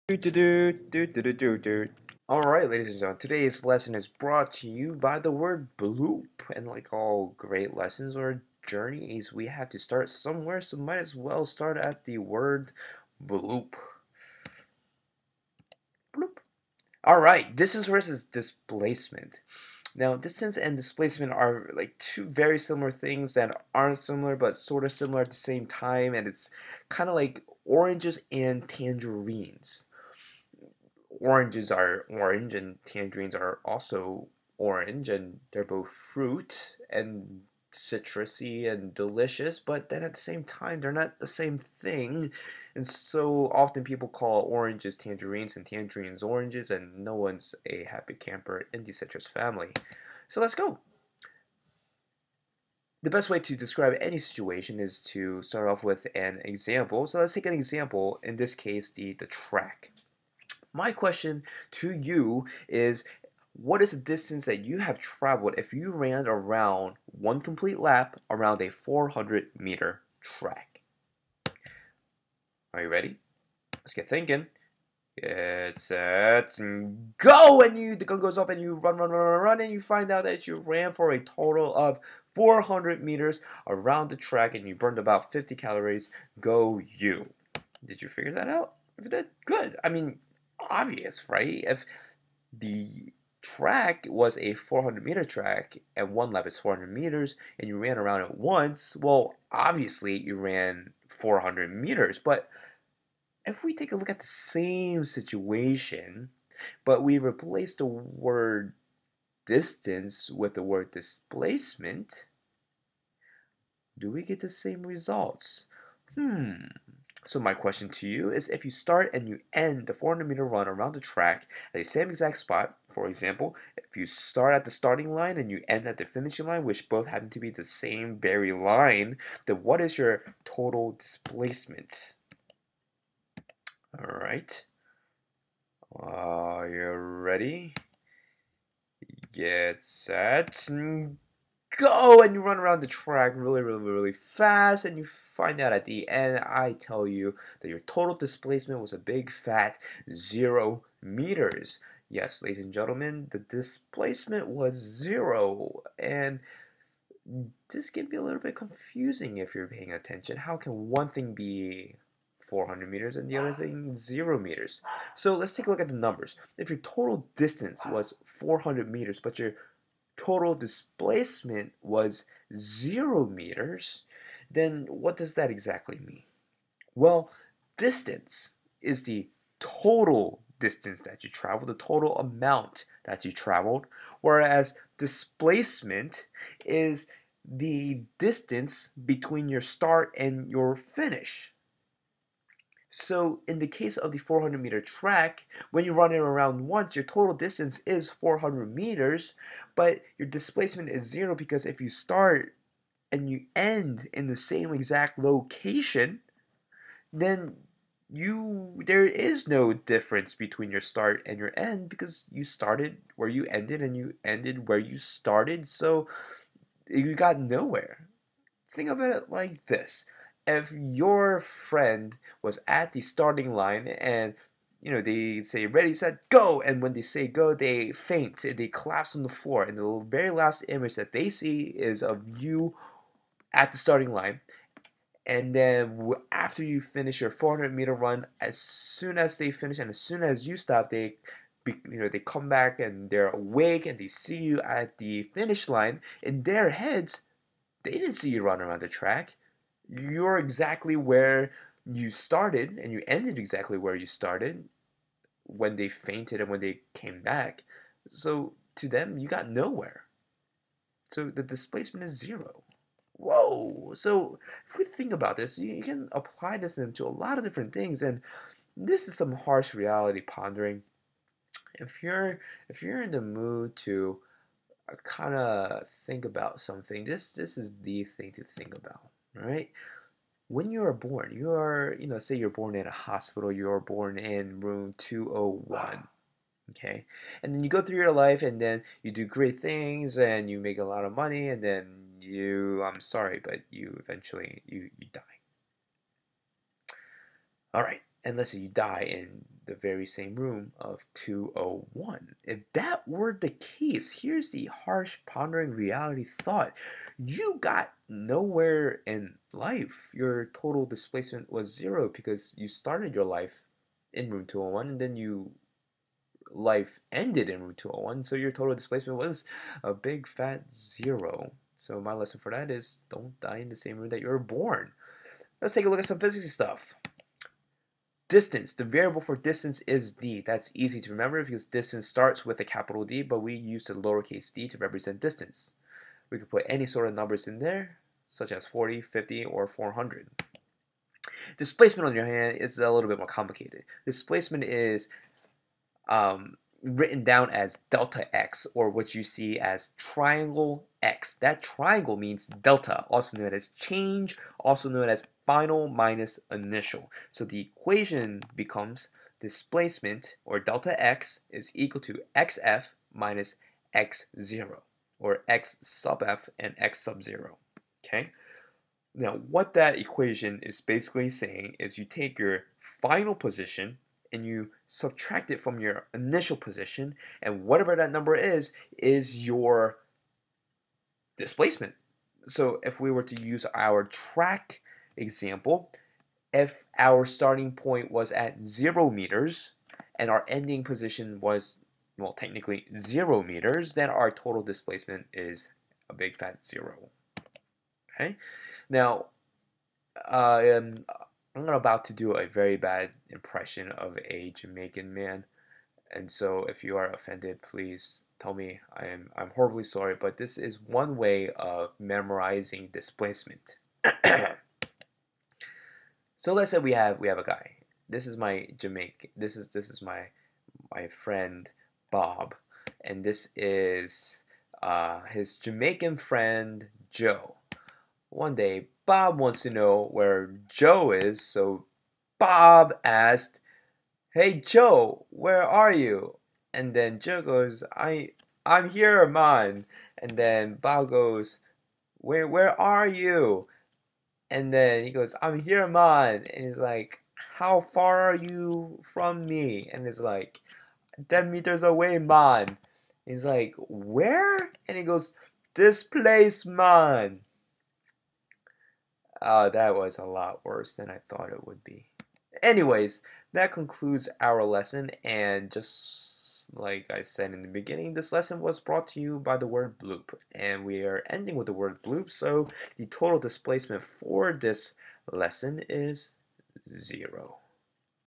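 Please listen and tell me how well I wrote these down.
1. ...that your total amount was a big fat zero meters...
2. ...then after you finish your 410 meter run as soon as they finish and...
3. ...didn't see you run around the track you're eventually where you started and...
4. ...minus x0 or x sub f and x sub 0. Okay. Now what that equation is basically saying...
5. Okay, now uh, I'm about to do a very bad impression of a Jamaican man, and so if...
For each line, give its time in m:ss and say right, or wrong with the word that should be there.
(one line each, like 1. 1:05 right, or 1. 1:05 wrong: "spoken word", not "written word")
1. 2:27 wrong: "displacement", not "amount"
2. 3:55 wrong: "400", not "410"
3. 4:07 wrong: "exactly", not "eventually"
4. 6:03 right
5. 6:38 right.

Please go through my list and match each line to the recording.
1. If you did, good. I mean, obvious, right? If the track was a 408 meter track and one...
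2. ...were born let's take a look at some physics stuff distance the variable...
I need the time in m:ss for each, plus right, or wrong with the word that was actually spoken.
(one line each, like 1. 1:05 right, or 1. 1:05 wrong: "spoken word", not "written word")
1. 1:28 wrong: "400", not "408"
2. 5:24 right.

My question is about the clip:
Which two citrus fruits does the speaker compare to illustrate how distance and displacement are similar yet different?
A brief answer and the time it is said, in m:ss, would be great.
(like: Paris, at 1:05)
oranges and tangerines, at 0:27.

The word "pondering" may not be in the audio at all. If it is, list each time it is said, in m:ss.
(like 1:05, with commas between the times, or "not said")
4:30, 5:05.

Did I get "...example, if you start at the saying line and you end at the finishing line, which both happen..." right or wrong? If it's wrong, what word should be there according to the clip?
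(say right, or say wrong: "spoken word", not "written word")
wrong: "starting", not "saying".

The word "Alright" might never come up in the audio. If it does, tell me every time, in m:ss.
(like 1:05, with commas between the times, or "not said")
0:02, 0:17.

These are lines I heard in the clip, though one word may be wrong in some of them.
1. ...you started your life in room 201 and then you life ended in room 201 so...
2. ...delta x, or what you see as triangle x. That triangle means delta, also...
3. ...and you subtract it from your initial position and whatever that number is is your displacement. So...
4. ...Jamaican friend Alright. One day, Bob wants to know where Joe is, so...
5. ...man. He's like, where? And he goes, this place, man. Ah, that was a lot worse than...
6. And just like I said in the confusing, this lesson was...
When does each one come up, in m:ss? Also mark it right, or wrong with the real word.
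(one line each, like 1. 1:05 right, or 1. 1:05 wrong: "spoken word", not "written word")
1. 5:12 right
2. 5:47 right
3. 6:14 right
4. 7:05 wrong: "Joe", not "Alright"
5. 7:32 right
6. 7:45 wrong: "beginning", not "confusing".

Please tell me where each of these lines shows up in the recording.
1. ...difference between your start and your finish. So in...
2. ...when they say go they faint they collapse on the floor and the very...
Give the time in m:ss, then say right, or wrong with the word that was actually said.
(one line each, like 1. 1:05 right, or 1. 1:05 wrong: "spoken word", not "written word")
1. 3:08 wrong: "distance", not "difference"
2. 3:46 right.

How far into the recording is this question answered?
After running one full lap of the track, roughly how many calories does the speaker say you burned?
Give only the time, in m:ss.
1:25.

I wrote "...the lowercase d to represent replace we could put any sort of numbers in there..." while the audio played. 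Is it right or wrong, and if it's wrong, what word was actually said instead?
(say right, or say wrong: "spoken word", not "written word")
wrong: "distance", not "replace".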